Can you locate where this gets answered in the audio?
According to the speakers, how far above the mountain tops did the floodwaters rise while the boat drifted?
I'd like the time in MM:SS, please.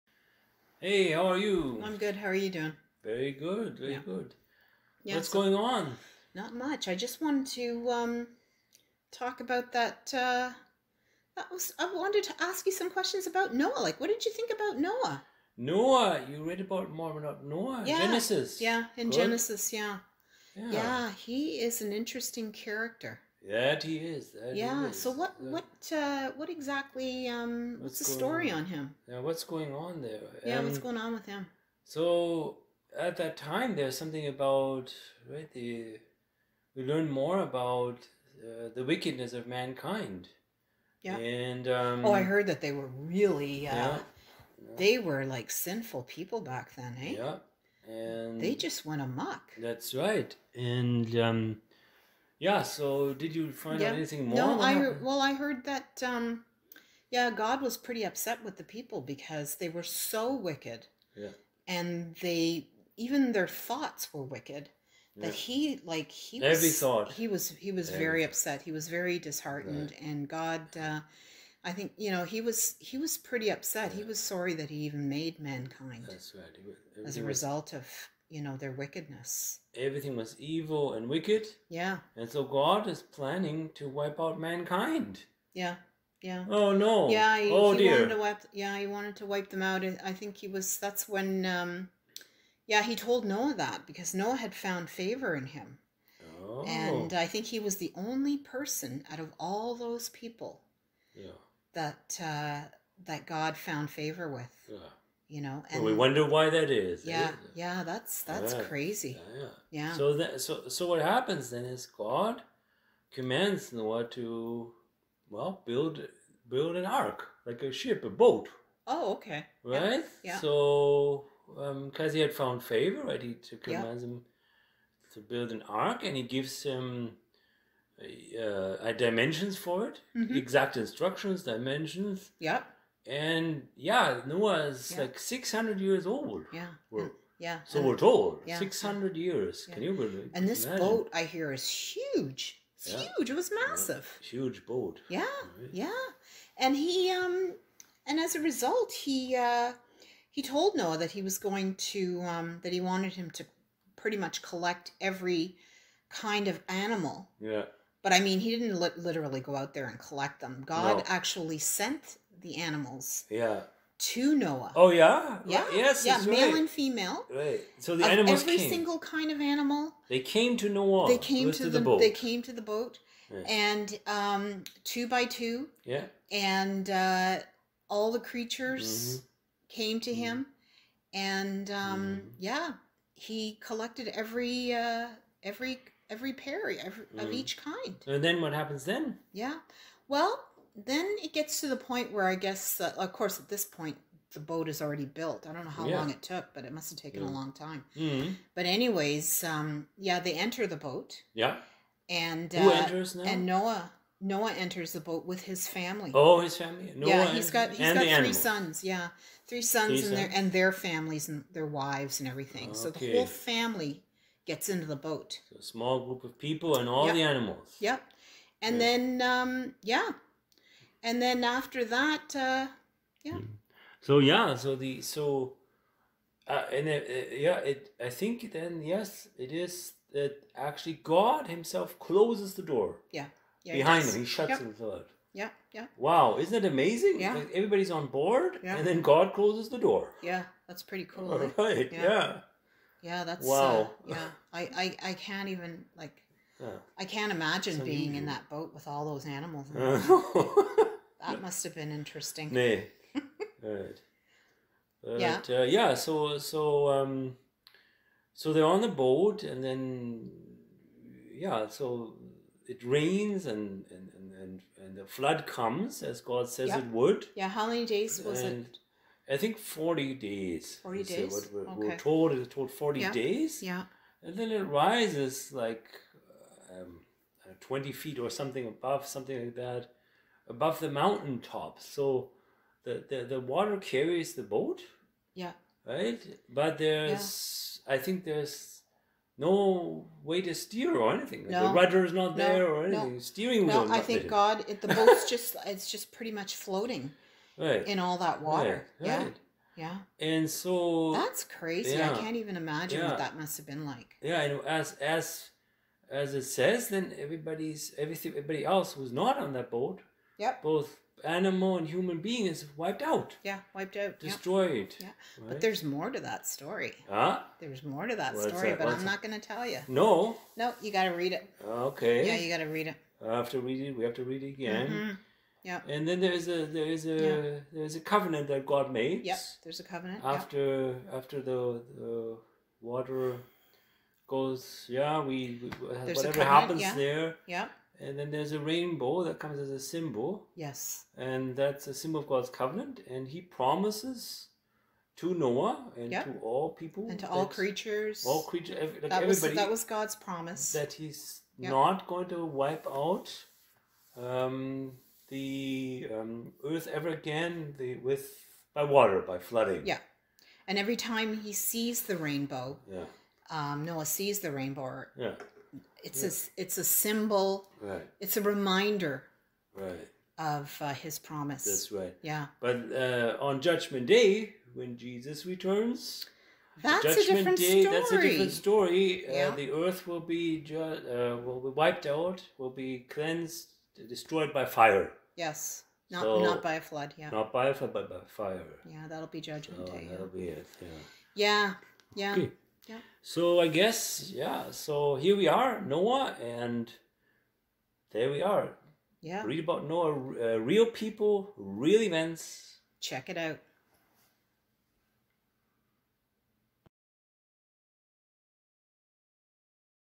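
04:37.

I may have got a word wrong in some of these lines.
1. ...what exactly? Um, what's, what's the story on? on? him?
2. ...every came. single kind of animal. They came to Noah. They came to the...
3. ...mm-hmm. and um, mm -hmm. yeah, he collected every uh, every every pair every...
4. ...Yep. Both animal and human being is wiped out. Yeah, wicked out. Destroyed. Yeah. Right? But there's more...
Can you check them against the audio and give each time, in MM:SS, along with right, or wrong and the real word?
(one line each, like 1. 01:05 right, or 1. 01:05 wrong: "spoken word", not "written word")
1. 00:26 right
2. 02:48 right
3. 03:00 right
4. 05:10 wrong: "wiped", not "wicked".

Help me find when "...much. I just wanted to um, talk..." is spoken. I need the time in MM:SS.
00:06.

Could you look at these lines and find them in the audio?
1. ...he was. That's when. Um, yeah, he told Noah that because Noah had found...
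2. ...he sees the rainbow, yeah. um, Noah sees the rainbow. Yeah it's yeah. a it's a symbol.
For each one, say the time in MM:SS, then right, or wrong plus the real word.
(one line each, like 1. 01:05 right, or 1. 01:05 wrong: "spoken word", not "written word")
1. 01:30 right
2. 06:01 right.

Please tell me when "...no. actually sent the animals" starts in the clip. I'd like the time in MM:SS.
02:40.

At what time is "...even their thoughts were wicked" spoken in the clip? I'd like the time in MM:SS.
01:02.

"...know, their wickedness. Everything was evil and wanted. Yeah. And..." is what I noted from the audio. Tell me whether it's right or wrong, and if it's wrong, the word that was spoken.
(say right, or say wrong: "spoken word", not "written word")
wrong: "wicked", not "wanted".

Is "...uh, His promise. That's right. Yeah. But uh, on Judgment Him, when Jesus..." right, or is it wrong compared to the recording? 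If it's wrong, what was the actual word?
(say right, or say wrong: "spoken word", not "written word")
wrong: "Day", not "Him".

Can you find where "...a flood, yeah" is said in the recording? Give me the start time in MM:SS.
06:26.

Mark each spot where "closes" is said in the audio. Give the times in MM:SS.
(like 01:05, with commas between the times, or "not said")
03:51, 03:59.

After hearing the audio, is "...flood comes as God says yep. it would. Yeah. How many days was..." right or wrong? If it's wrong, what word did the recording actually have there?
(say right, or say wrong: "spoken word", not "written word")
right.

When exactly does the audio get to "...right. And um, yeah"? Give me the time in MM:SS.
00:49.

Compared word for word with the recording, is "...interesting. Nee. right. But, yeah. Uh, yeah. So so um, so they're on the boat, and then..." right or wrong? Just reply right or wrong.
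right.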